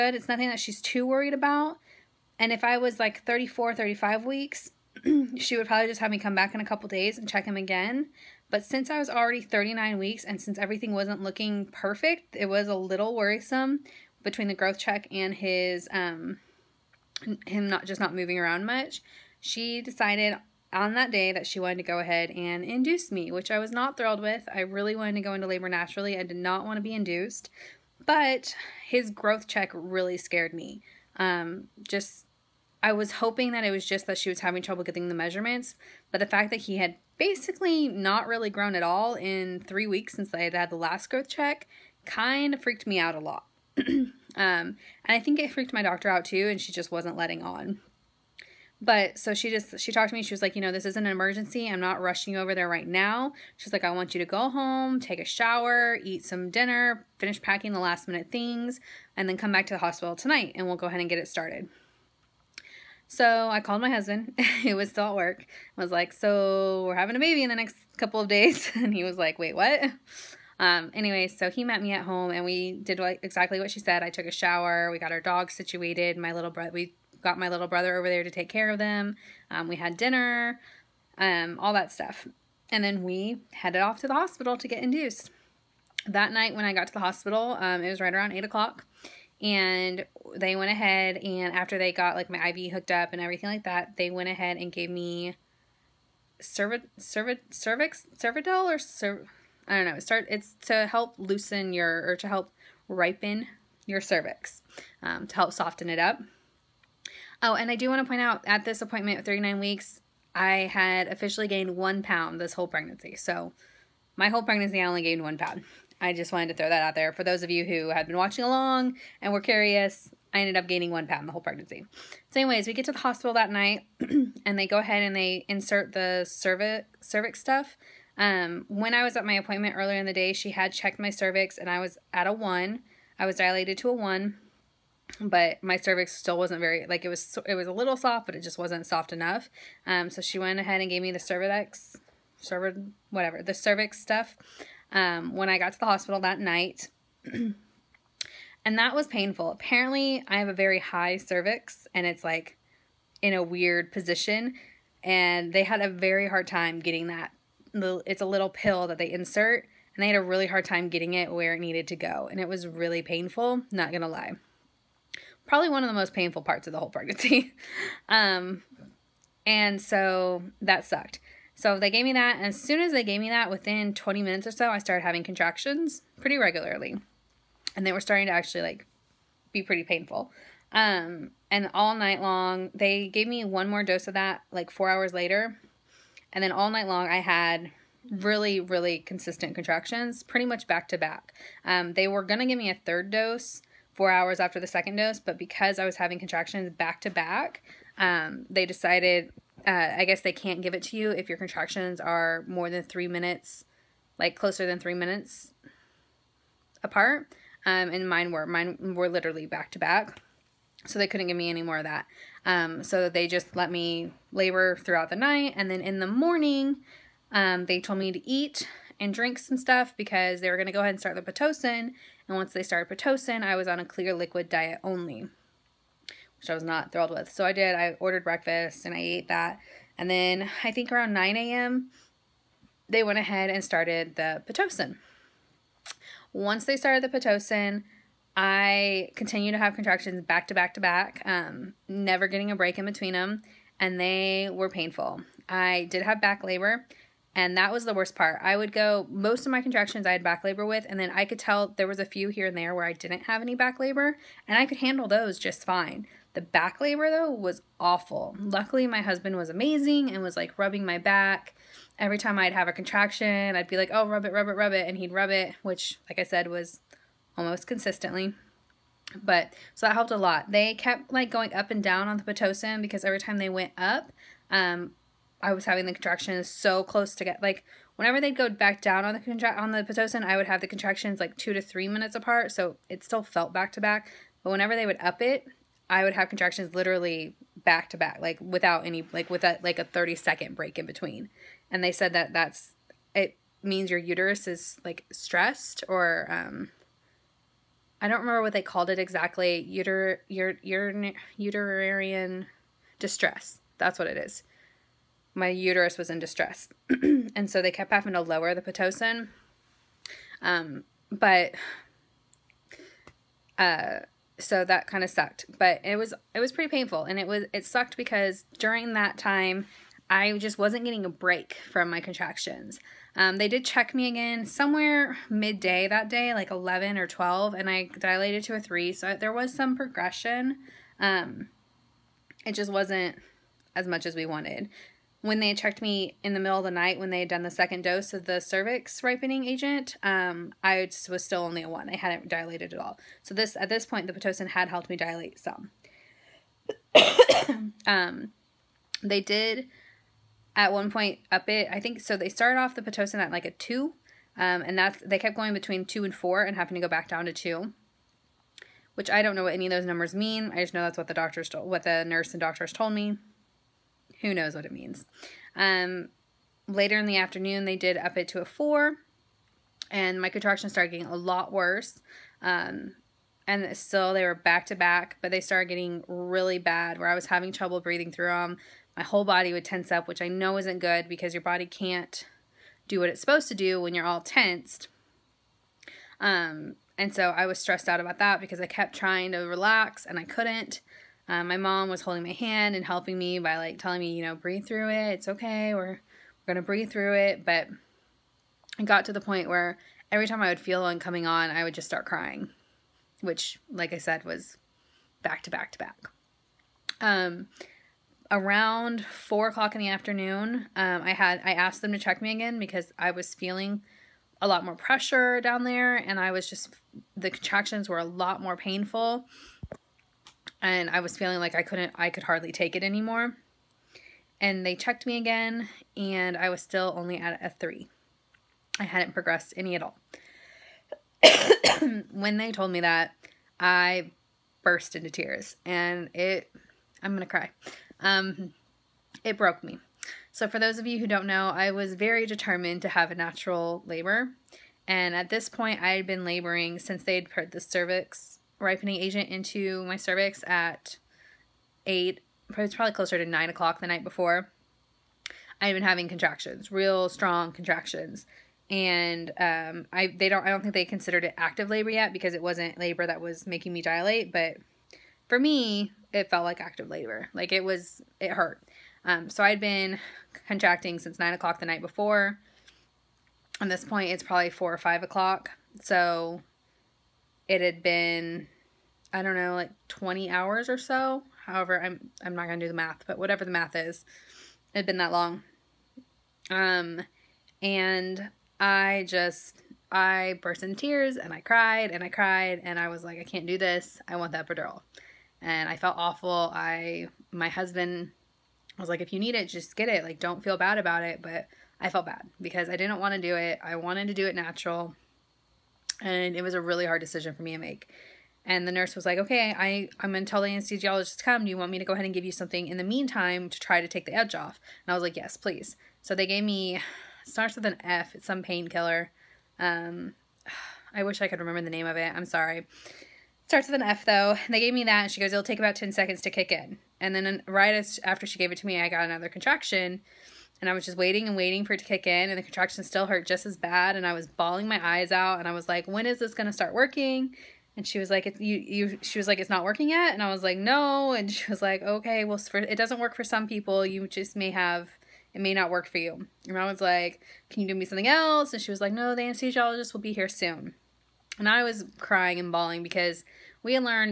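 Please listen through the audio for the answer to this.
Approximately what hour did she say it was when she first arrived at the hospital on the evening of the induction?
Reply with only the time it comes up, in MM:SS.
01:28.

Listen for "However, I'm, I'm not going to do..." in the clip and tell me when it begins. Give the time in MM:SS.
08:01.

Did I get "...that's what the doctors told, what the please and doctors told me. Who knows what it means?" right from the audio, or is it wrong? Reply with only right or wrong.
wrong.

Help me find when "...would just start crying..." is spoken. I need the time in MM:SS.
06:41.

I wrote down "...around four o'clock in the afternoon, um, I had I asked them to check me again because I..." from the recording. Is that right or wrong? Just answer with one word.
right.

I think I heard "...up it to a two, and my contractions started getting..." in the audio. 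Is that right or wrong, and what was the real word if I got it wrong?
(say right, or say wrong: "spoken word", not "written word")
wrong: "four", not "two".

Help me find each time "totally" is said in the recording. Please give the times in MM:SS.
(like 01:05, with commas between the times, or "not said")
not said.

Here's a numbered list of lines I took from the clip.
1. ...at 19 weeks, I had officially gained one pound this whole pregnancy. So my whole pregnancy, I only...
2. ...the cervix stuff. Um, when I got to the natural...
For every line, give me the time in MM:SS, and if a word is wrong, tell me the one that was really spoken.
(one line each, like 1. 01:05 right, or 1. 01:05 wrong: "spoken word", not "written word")
1. 01:49 wrong: "39", not "19"
2. 02:23 wrong: "hospital", not "natural".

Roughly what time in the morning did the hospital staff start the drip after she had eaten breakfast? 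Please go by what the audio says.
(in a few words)
9 a.m.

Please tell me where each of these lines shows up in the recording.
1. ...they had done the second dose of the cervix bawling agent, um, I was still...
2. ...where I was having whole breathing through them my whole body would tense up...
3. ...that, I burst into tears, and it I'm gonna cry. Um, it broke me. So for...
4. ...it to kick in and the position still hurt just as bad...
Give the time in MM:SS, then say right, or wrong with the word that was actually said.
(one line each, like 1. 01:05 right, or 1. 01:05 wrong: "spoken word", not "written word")
1. 05:37 wrong: "ripening", not "bawling"
2. 06:16 wrong: "trouble", not "whole"
3. 07:12 right
4. 08:51 wrong: "contraction", not "position".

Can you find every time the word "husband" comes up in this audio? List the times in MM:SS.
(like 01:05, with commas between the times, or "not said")
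01:03, 04:19, 08:17.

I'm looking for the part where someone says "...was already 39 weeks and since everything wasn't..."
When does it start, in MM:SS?
00:08.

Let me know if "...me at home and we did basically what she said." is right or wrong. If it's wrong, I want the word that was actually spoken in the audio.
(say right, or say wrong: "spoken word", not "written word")
wrong: "exactly", not "basically".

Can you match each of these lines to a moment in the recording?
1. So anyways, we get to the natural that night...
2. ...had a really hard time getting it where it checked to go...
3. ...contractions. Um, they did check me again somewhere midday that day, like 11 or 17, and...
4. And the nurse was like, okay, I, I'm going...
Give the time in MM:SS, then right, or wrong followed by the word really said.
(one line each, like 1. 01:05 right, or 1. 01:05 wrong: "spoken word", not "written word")
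1. 02:02 wrong: "hospital", not "natural"
2. 02:40 wrong: "needed", not "checked"
3. 05:22 wrong: "12", not "17"
4. 08:28 right.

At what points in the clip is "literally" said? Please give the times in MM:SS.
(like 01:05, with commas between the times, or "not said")
03:29, 04:46.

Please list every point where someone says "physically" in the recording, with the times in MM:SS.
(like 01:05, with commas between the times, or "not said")
not said.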